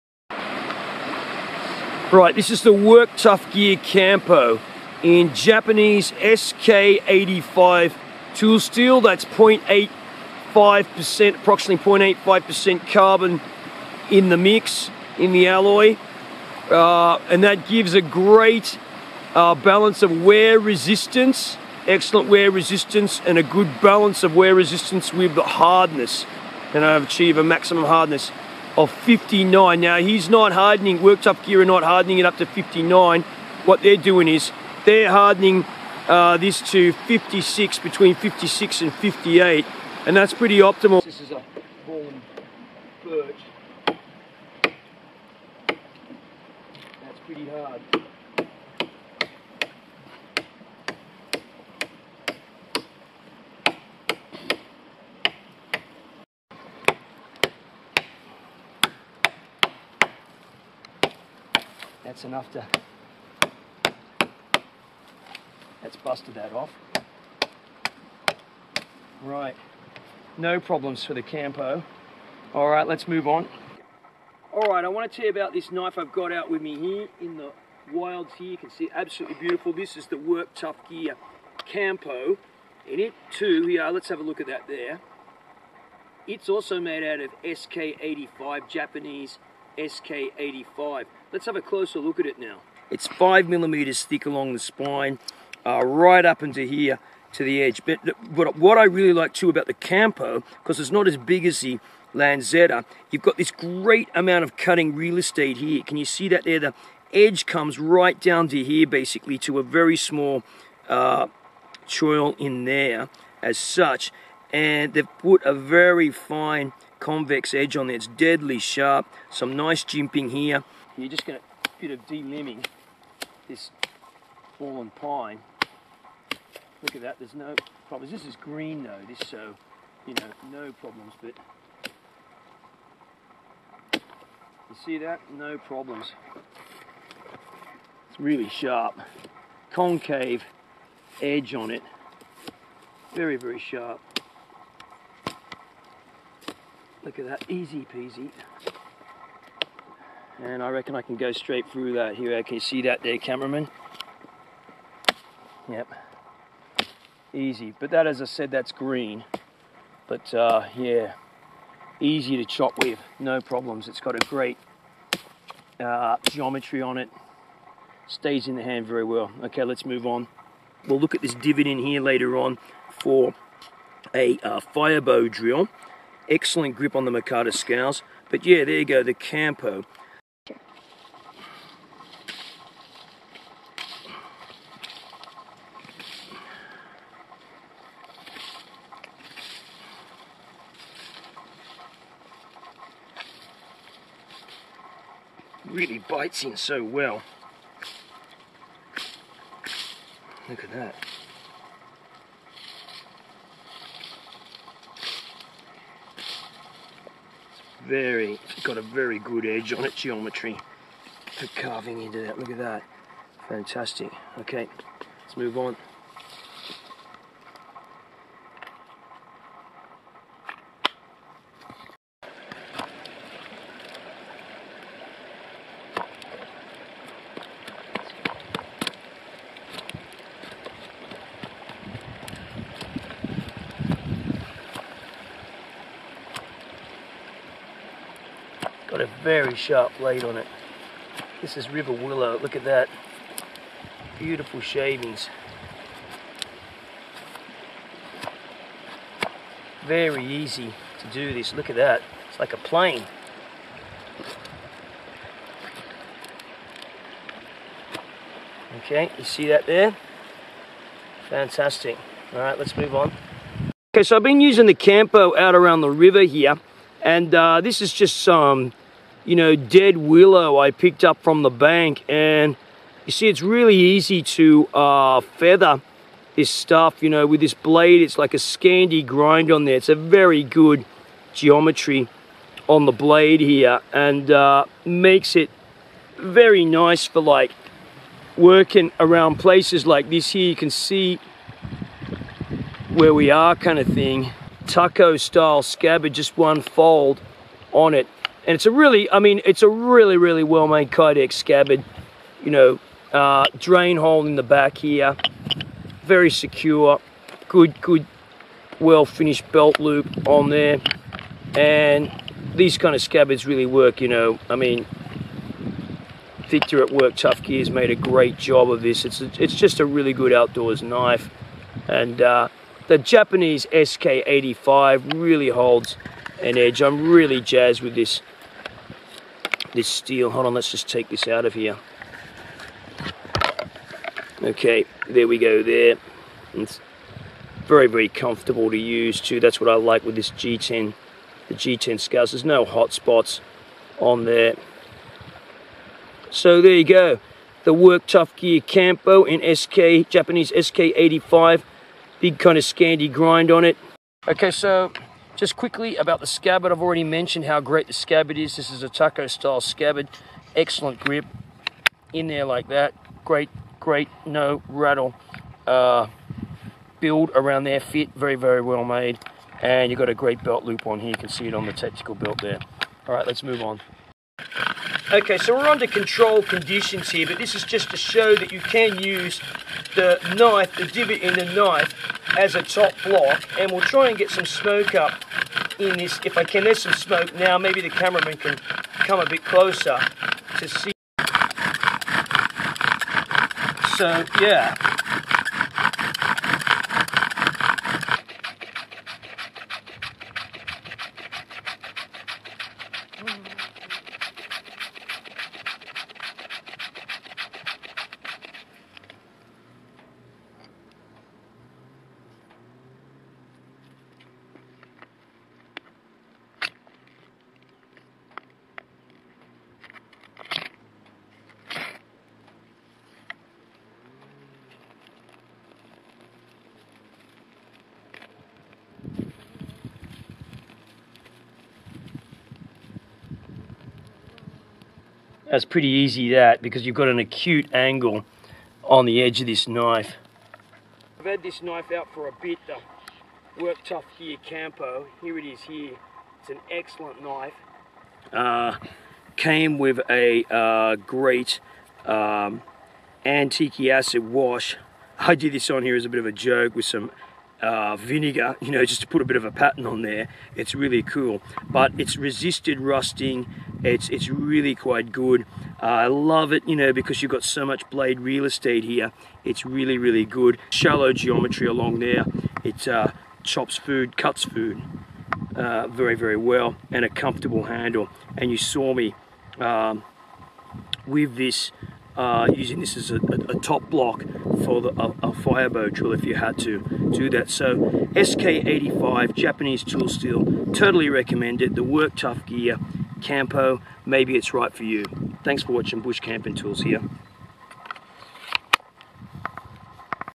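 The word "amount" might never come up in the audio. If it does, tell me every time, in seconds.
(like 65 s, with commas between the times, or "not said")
104 s.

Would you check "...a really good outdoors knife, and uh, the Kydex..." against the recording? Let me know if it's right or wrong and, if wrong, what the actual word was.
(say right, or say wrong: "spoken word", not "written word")
wrong: "Japanese", not "Kydex".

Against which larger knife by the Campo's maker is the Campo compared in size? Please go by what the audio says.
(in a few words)
The Lanzeta.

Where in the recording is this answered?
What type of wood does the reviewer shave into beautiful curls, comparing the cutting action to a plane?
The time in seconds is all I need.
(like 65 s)
241 s.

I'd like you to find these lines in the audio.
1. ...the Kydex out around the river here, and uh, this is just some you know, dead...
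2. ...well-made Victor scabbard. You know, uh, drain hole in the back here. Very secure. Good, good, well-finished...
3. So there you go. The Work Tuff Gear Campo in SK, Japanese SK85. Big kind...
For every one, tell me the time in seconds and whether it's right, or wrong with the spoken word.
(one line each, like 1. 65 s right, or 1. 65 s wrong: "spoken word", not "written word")
1. 264 s wrong: "Campo", not "Kydex"
2. 300 s wrong: "Kydex", not "Victor"
3. 346 s right.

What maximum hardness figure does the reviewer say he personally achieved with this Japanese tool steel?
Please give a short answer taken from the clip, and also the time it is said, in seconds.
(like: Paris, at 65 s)
59, at 26 s.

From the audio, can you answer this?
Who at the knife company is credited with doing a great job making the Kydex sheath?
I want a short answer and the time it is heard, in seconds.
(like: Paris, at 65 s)
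Victor, at 316 s.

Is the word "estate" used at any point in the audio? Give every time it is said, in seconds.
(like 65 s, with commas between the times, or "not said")
105 s, 468 s.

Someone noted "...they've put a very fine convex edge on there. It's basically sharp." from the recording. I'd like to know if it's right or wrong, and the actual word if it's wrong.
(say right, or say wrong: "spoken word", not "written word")
wrong: "deadly", not "basically".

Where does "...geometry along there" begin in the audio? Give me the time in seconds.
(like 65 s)
471 s.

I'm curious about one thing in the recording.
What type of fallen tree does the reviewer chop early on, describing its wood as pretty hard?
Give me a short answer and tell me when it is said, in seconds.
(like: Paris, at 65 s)
Birch, at 41 s.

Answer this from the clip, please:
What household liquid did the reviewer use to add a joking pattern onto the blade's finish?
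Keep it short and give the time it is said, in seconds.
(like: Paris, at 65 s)
Vinegar, at 457 s.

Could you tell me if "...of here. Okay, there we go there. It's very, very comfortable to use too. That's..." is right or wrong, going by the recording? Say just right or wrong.
right.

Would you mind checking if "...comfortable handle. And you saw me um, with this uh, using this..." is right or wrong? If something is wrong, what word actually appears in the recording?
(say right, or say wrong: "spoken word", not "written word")
right.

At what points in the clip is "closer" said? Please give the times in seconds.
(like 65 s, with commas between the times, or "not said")
91 s, 389 s.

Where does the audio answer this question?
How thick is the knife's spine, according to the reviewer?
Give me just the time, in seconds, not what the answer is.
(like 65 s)
93 s.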